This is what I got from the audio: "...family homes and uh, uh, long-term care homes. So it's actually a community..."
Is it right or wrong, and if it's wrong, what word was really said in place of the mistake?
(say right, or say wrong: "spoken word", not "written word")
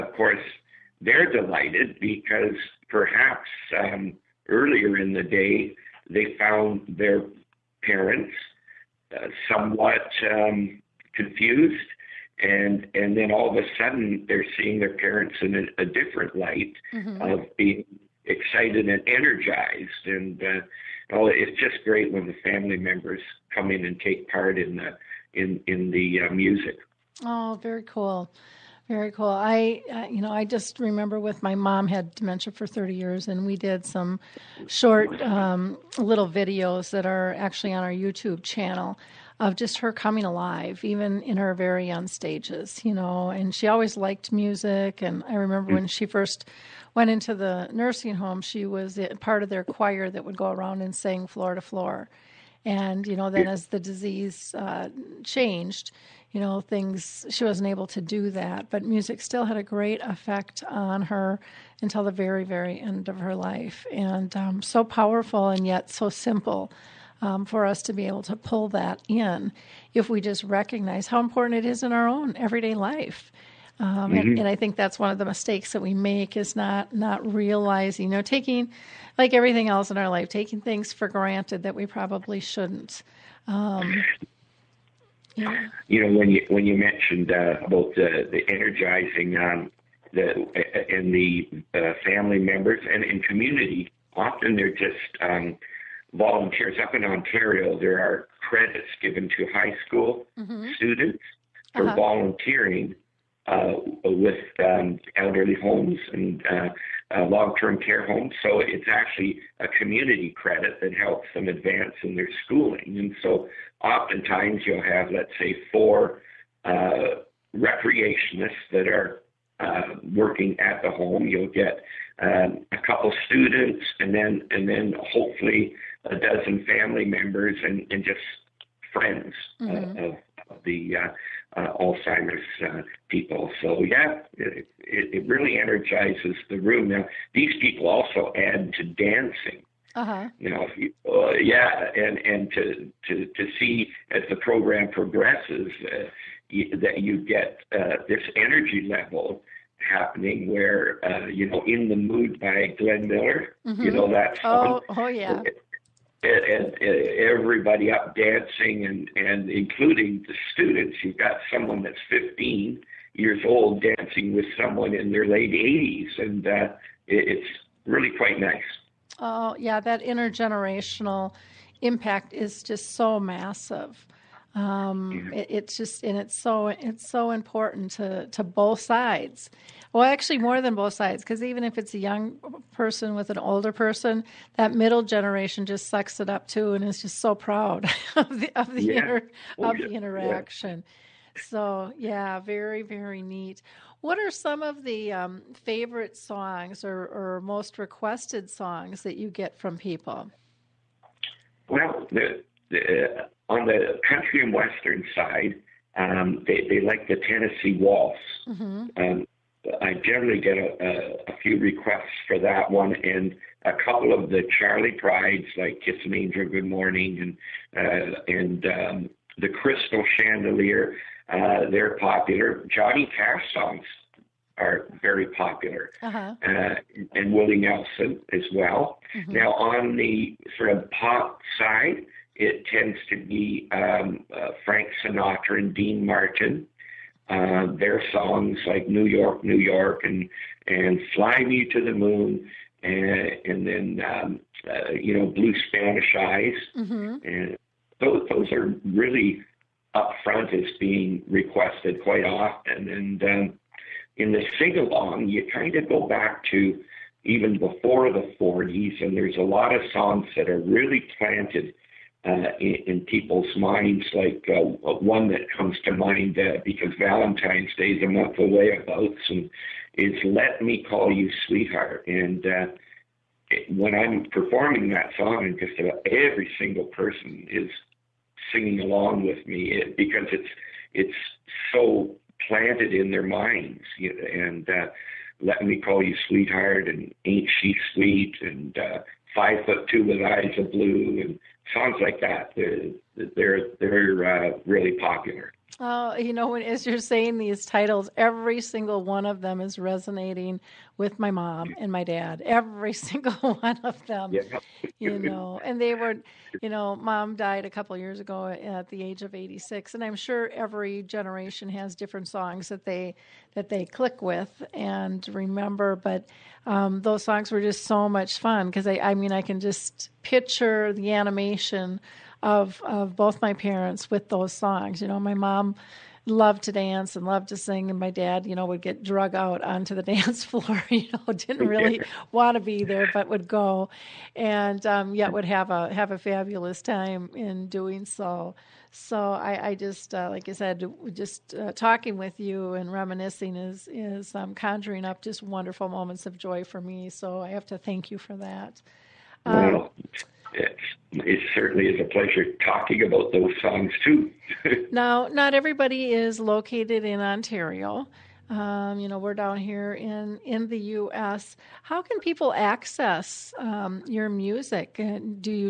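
wrong: "elderly", not "family".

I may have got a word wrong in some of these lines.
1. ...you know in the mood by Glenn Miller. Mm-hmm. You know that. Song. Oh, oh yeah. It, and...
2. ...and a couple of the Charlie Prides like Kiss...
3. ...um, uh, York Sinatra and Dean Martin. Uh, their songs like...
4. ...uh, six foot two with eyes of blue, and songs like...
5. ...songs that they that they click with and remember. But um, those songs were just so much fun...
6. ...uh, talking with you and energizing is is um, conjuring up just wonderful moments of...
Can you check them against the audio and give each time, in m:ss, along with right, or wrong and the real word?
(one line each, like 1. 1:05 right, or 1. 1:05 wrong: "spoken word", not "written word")
1. 2:31 right
2. 3:32 right
3. 3:53 wrong: "Frank", not "York"
4. 4:48 wrong: "five", not "six"
5. 5:12 right
6. 5:41 wrong: "reminiscing", not "energizing".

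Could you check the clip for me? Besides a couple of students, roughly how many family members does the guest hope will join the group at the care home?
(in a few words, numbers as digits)
A dozen.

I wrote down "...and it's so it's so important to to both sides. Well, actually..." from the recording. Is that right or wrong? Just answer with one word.
right.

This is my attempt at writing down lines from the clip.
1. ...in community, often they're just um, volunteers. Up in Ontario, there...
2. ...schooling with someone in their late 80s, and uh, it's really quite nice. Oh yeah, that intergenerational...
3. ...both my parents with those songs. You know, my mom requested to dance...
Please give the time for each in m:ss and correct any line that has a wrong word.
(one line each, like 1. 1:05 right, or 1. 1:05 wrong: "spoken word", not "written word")
1. 1:33 right
2. 2:43 wrong: "dancing", not "schooling"
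3. 5:23 wrong: "loved", not "requested".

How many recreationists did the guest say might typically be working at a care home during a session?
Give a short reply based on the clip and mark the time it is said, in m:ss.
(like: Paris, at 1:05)
4, at 1:55.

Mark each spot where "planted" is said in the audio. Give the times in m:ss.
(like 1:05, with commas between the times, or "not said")
4:21, 4:42.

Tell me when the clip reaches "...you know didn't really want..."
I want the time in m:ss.
5:30.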